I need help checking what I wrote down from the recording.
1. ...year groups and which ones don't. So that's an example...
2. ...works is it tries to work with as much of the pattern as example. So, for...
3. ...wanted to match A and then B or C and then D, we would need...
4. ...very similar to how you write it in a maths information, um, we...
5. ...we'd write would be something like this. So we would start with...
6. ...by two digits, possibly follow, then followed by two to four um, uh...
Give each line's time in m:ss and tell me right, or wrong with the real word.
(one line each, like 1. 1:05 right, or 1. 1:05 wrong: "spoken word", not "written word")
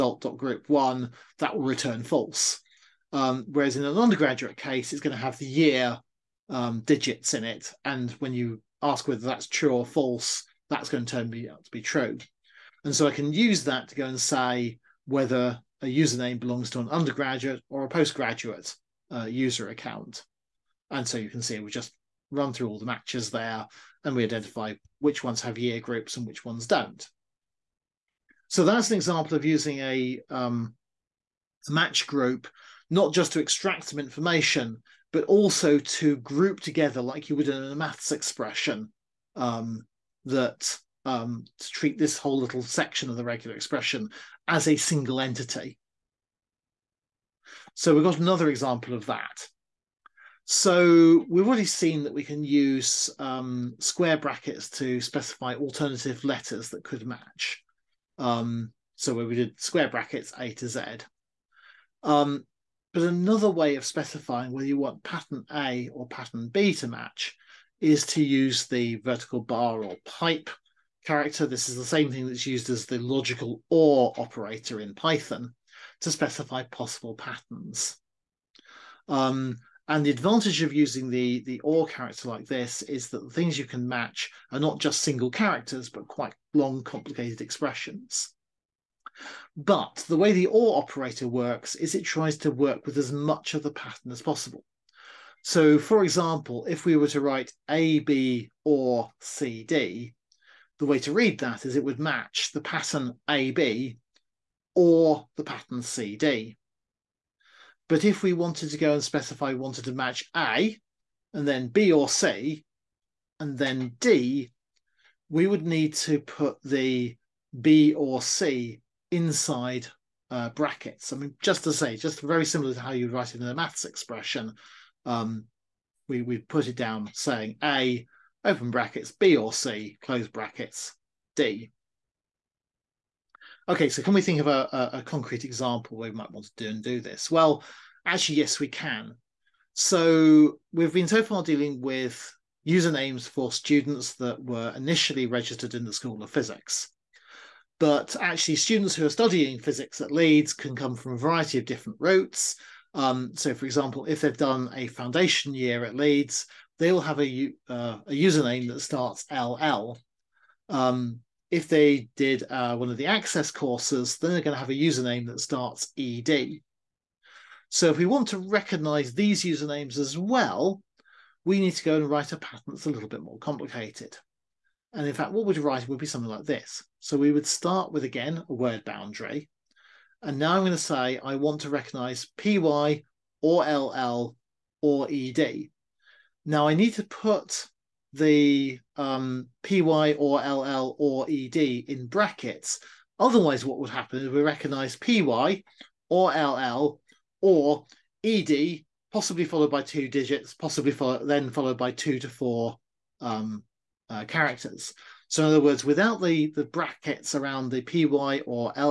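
1. 0:25 right
2. 1:31 wrong: "possible", not "example"
3. 1:49 right
4. 2:02 wrong: "expression", not "information"
5. 2:55 right
6. 3:19 right.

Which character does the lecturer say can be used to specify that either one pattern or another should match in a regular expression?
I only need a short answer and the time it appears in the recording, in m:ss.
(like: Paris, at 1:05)
vertical bar or pipe, at 1:08.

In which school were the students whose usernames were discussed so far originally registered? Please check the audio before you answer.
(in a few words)
School of Physics.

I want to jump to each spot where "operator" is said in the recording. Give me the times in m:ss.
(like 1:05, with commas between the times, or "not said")
1:14, 1:30.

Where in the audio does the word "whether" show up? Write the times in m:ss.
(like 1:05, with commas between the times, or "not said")
0:09, 0:15, 1:04.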